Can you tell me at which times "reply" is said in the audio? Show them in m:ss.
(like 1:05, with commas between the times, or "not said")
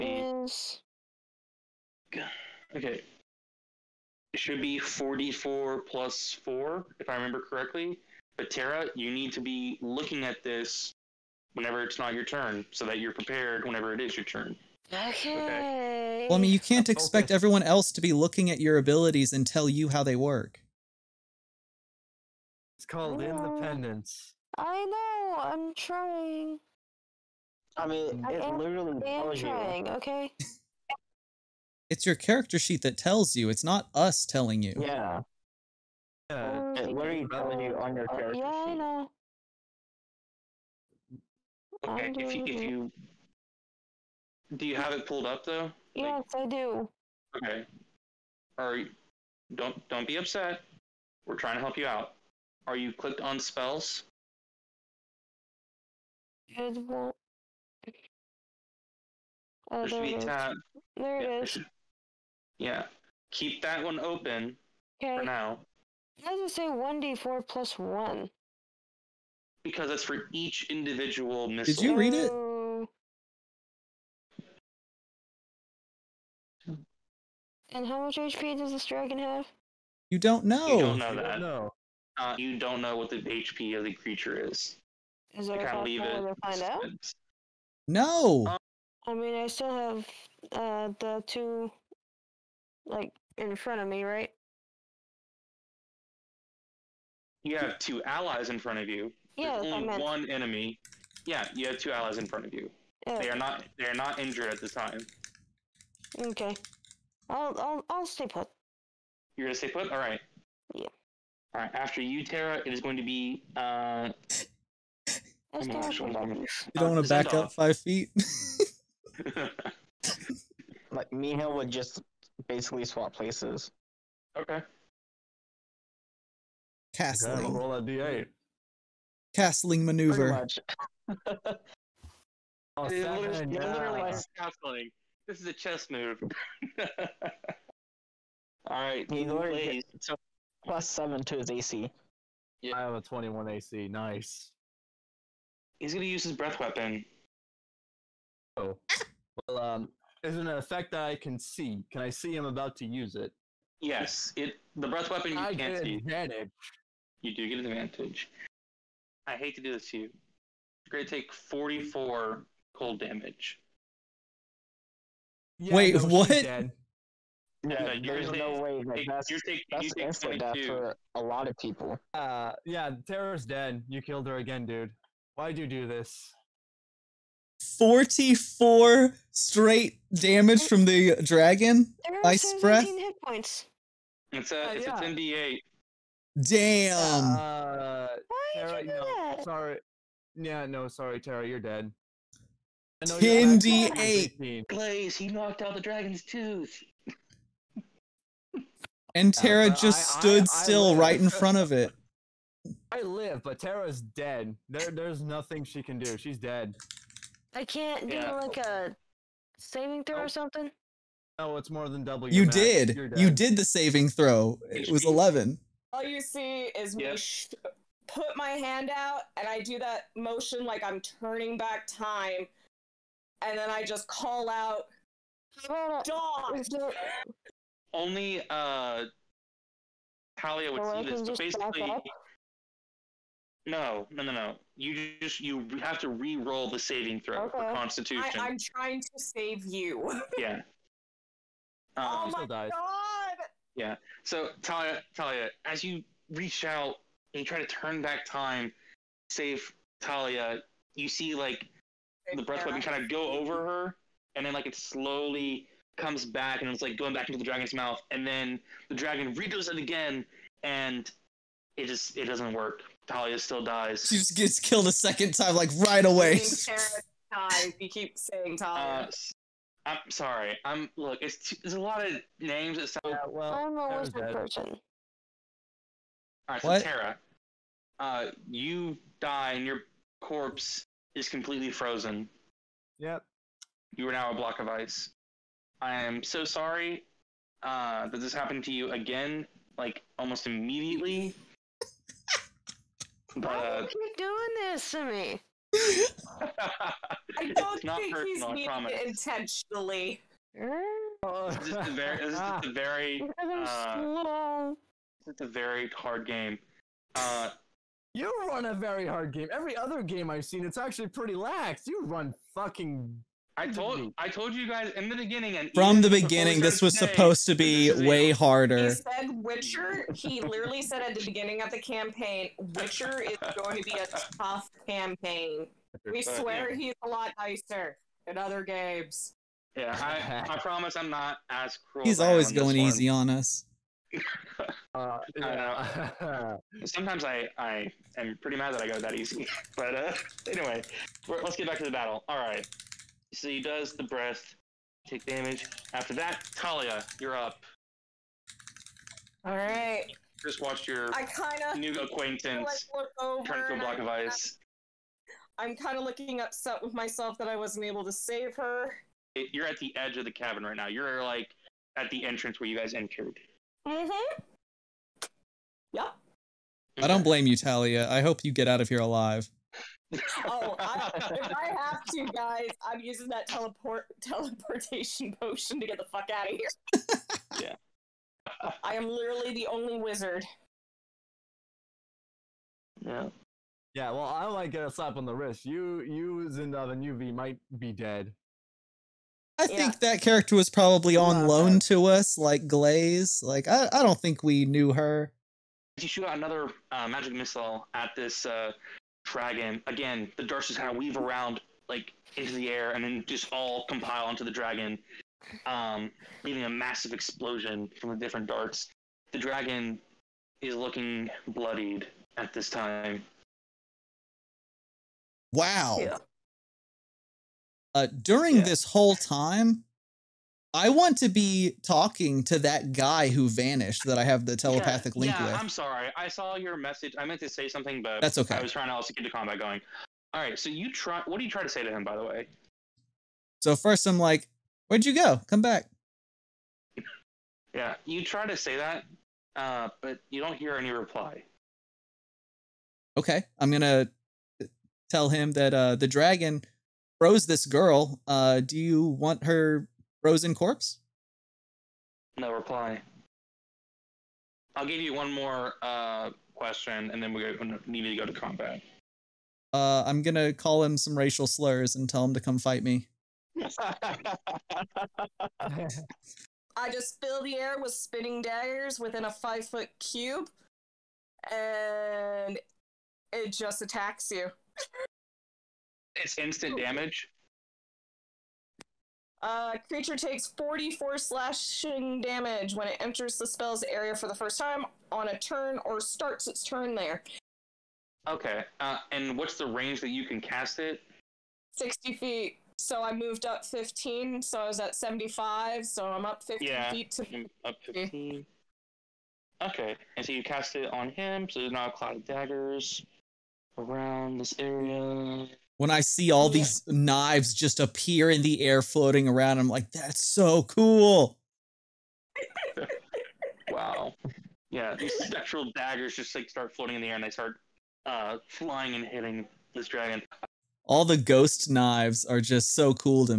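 7:20, 7:32.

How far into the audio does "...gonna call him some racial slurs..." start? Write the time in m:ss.
7:40.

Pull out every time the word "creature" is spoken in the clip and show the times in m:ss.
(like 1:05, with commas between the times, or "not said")
1:23, 7:59.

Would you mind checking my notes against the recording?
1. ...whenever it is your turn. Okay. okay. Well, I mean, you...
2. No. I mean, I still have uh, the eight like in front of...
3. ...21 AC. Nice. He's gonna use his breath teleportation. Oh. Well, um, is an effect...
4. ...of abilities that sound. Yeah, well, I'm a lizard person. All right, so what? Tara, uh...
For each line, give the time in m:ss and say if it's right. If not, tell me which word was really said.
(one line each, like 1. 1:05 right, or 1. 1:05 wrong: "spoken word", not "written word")
1. 0:13 right
2. 1:27 wrong: "two", not "eight"
3. 2:23 wrong: "weapon", not "teleportation"
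4. 4:32 wrong: "names", not "abilities".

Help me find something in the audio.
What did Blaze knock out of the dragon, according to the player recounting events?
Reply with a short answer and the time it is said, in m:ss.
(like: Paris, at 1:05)
the dragon's tooth, at 3:15.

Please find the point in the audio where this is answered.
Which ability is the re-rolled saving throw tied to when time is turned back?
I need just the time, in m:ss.
3:57.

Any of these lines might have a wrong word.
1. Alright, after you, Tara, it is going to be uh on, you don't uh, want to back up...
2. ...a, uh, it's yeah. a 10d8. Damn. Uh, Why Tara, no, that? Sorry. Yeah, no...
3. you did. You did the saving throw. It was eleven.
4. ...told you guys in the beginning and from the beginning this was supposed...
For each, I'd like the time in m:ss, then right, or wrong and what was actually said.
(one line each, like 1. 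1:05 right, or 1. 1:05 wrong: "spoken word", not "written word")
1. 1:51 right
2. 3:04 right
3. 3:32 right
4. 5:14 right.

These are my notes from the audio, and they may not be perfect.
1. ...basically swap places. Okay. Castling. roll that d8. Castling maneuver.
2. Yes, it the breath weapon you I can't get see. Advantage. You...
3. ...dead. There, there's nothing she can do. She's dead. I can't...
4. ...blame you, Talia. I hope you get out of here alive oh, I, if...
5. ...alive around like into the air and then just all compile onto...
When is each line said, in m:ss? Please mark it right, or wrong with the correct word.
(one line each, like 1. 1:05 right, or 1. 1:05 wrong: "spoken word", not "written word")
1. 2:02 right
2. 2:33 right
3. 3:24 right
4. 6:07 right
5. 6:40 wrong: "weave", not "alive".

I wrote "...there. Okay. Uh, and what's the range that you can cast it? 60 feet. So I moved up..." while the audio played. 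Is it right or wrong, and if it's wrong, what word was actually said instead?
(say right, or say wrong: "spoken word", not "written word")
right.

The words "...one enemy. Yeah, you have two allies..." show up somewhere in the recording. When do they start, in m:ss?
1:40.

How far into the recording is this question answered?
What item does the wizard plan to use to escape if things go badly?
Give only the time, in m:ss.
6:14.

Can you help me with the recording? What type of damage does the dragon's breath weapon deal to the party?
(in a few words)
cold.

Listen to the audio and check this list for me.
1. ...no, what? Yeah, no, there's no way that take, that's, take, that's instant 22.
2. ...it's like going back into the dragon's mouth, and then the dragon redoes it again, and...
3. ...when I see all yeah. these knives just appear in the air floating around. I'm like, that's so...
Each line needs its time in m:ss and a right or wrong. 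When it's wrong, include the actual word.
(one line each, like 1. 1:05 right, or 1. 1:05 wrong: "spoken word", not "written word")
1. 2:45 right
2. 4:16 right
3. 8:25 right.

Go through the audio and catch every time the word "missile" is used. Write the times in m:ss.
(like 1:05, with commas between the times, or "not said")
1:11, 6:37.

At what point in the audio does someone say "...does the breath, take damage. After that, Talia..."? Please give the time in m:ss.
5:43.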